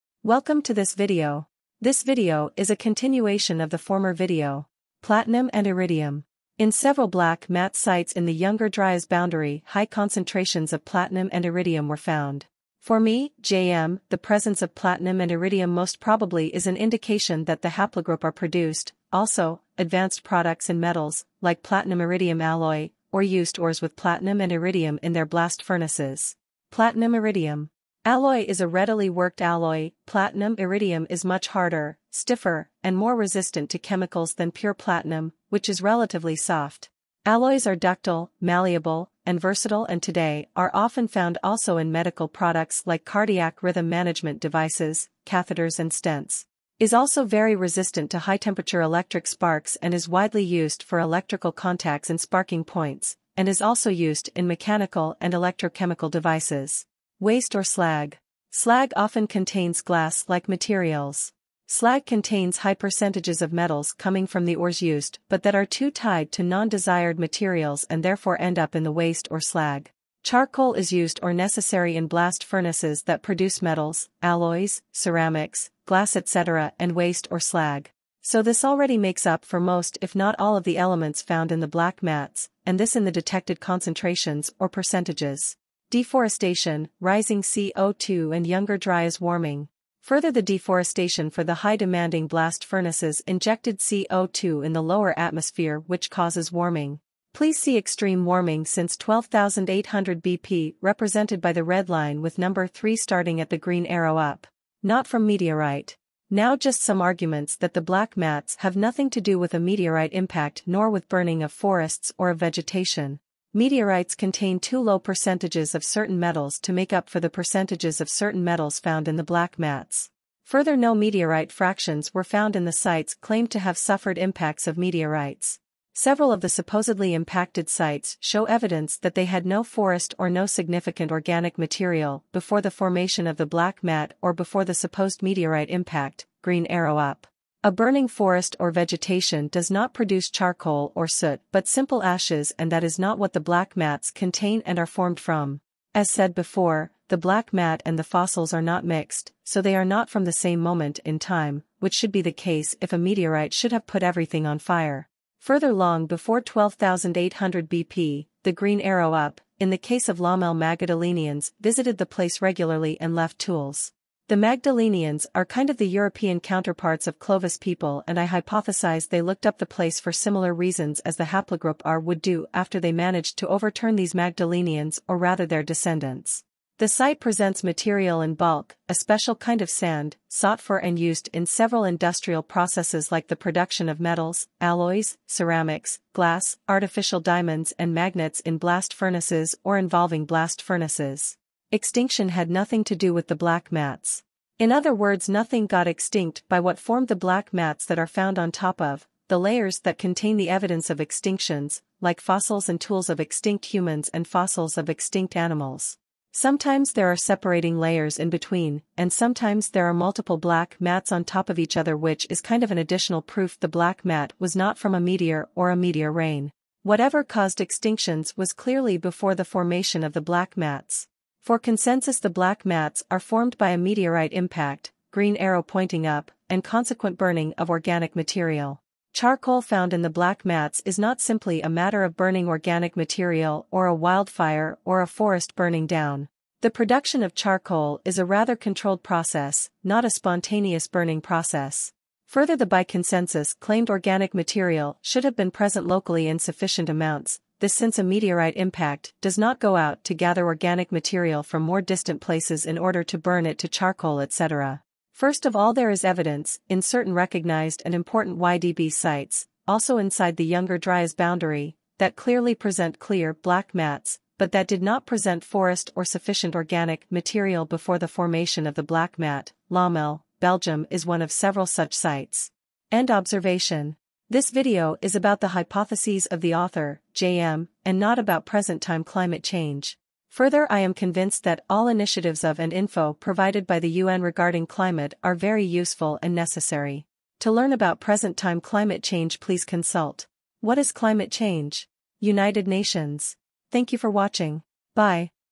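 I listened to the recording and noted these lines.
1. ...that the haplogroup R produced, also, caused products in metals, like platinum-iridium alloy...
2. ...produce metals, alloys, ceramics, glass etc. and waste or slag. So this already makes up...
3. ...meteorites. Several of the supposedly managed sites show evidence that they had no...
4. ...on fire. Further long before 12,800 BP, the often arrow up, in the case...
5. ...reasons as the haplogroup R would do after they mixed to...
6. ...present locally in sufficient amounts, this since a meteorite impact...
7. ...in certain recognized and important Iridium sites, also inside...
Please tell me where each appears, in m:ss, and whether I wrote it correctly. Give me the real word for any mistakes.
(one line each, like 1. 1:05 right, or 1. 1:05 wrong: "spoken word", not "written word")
1. 0:17 wrong: "advanced", not "caused"
2. 1:13 right
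3. 2:04 wrong: "impacted", not "managed"
4. 2:34 wrong: "green", not "often"
5. 2:50 wrong: "managed", not "mixed"
6. 4:05 right
7. 4:16 wrong: "YDB", not "Iridium".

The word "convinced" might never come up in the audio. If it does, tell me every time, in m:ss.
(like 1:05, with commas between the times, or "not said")
4:40.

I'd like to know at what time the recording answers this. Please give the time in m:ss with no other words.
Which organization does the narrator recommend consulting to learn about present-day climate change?
4:52.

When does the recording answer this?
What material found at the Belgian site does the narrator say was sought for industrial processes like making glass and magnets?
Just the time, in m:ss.
2:58.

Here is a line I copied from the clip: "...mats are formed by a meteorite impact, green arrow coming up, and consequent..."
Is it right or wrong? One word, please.
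wrong.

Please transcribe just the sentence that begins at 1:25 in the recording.
Deforestation, rising CO2 and Younger Dryas warming.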